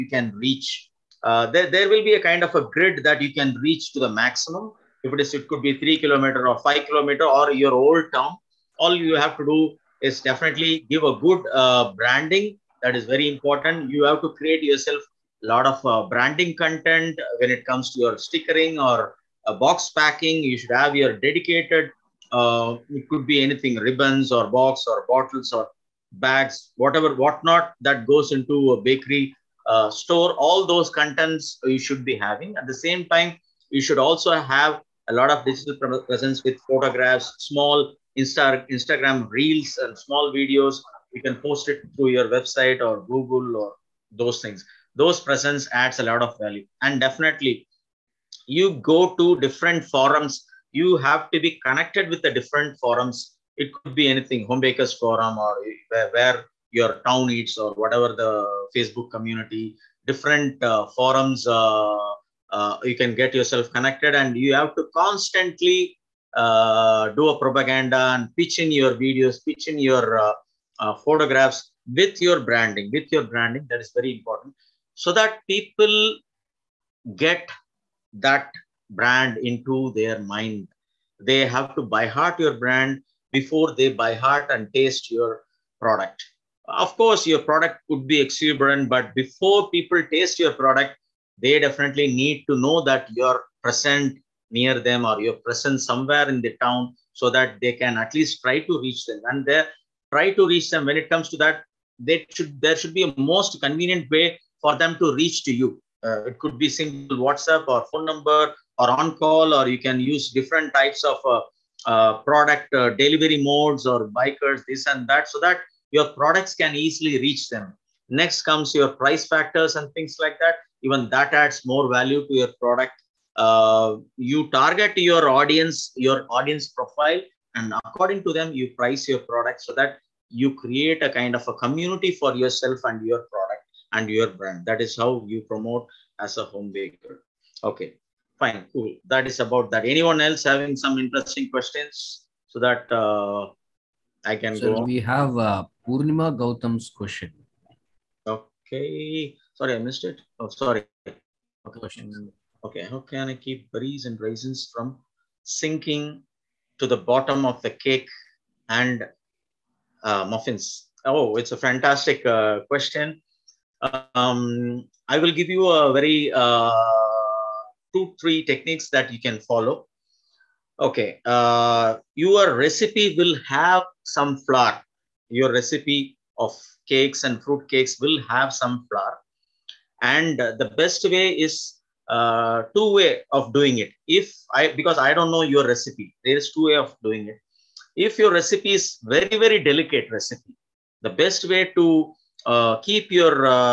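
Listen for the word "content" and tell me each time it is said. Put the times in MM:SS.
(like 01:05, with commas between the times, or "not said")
00:16, 00:30.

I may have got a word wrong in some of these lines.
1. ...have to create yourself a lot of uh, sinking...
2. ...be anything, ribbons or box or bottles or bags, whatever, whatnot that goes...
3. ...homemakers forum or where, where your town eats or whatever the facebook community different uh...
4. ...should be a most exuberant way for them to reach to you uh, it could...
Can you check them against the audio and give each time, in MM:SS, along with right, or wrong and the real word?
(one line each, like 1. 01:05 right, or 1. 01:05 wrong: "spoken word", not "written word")
1. 00:14 wrong: "branding", not "sinking"
2. 00:23 right
3. 00:54 right
4. 01:42 wrong: "convenient", not "exuberant".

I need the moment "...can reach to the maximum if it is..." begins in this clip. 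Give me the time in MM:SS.
00:03.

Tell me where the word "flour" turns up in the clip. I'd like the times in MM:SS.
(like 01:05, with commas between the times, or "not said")
02:54, 02:58.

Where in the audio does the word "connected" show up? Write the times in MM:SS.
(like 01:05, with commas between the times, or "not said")
00:51, 01:03.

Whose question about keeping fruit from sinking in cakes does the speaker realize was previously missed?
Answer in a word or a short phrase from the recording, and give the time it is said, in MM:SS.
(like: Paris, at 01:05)
Purnima Gautam, at 02:25.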